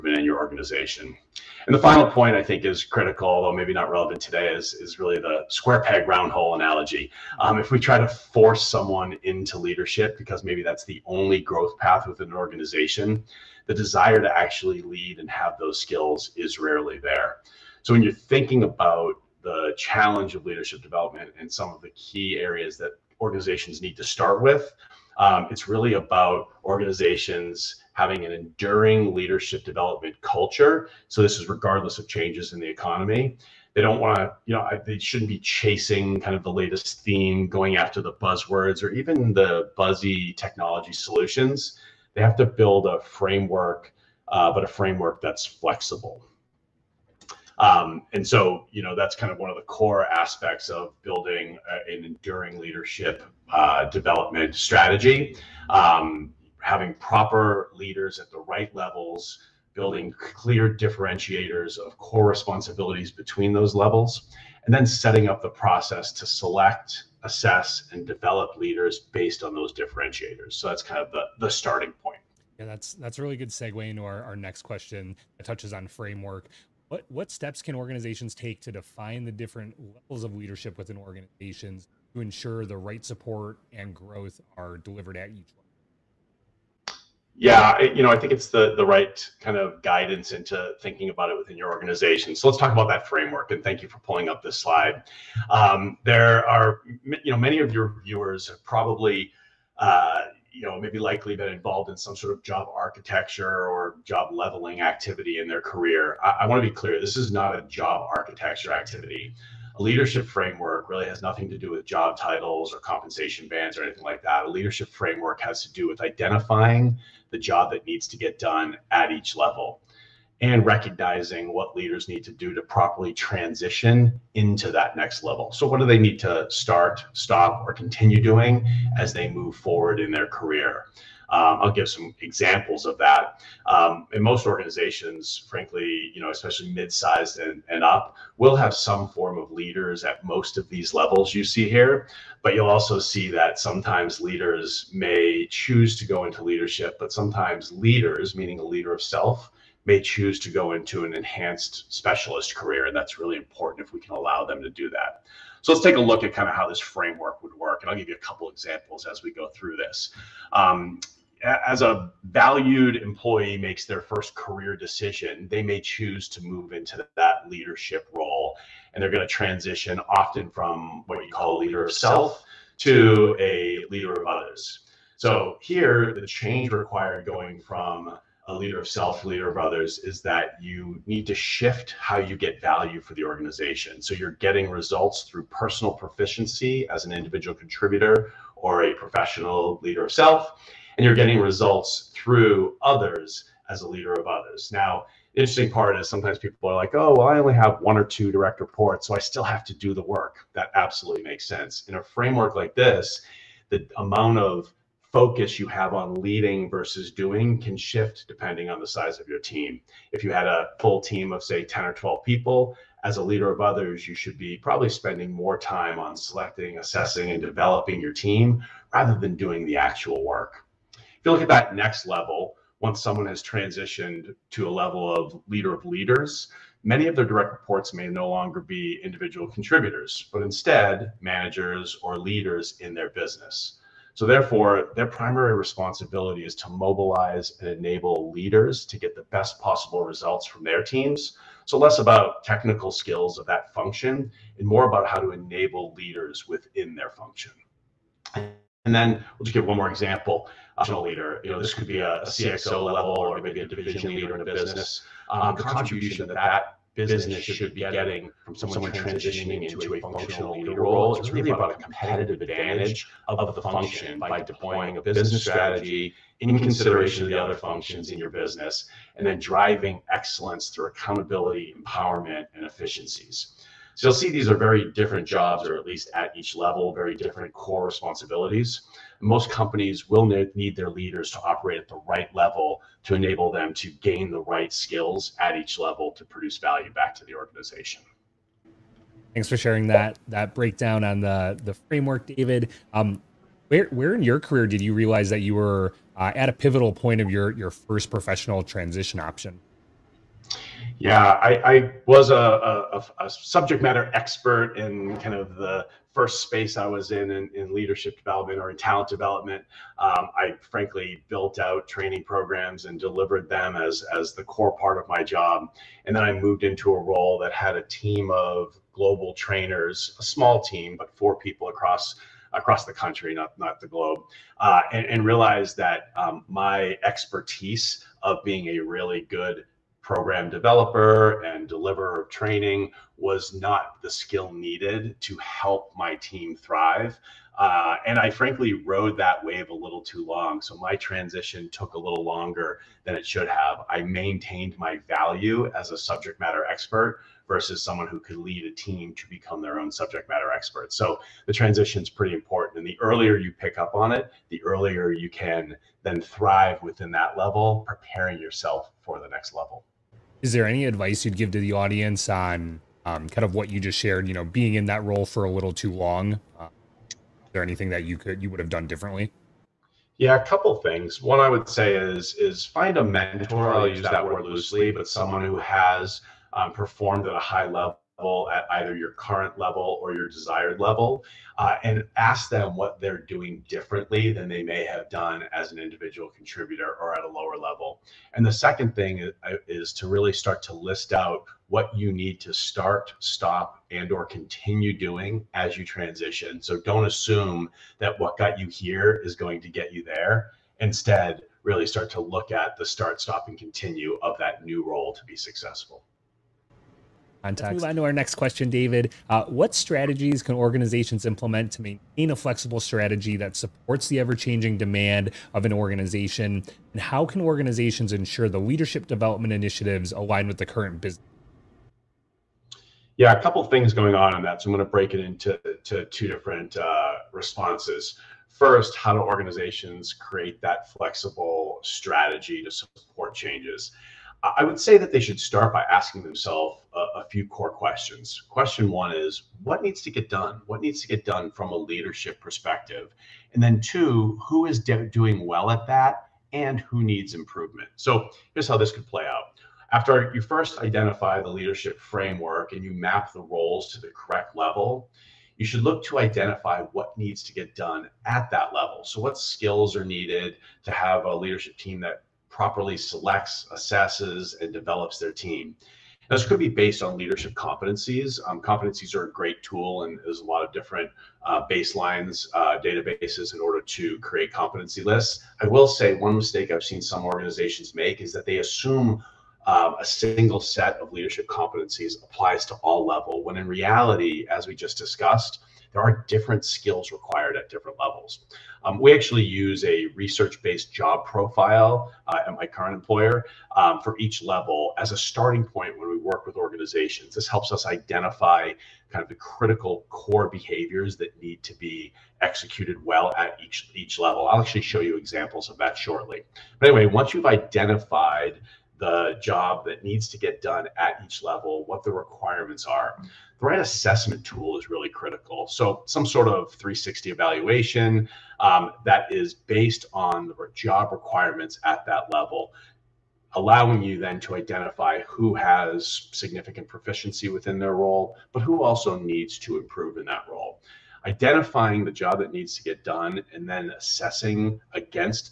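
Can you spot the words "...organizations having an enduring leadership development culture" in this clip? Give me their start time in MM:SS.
00:26.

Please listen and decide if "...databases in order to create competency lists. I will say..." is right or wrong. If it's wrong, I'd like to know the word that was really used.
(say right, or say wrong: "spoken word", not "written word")
right.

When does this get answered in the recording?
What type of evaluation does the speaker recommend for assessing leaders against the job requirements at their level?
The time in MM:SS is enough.
08:36.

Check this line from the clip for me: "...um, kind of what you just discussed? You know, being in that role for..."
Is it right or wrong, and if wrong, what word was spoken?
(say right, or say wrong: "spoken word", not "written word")
wrong: "shared", not "discussed".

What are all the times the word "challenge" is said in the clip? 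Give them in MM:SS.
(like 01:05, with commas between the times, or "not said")
00:19.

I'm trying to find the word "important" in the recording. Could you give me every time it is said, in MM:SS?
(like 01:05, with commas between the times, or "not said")
02:33, 05:52.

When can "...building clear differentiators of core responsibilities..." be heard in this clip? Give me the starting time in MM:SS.
00:59.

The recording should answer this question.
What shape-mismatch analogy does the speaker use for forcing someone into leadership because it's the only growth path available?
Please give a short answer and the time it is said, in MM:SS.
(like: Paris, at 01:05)
square peg round hole, at 00:05.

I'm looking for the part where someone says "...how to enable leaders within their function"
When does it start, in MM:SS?
04:05.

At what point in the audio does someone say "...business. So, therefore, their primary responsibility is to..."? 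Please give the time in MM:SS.
03:53.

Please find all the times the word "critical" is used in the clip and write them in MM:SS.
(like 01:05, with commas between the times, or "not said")
00:02, 08:19, 08:35.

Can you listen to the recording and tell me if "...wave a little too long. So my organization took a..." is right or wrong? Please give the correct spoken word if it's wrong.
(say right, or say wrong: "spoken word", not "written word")
wrong: "transition", not "organization".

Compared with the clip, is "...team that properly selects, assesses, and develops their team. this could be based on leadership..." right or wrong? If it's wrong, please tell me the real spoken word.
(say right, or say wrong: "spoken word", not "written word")
right.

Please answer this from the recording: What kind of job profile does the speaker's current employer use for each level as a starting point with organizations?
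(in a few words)
research based.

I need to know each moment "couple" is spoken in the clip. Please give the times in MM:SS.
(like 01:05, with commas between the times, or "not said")
02:38, 06:10, 07:03.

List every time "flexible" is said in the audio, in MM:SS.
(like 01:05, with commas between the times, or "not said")
00:45, 06:52, 07:10.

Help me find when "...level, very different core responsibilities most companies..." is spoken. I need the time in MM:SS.
04:36.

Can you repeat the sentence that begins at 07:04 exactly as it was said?
So I'm going to break it into to two different uh, responses.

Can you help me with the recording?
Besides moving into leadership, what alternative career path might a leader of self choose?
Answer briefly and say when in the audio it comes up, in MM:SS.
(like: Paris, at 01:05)
enhanced specialist career, at 02:31.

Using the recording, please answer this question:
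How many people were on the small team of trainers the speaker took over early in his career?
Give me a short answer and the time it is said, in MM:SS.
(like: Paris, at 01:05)
4, at 05:21.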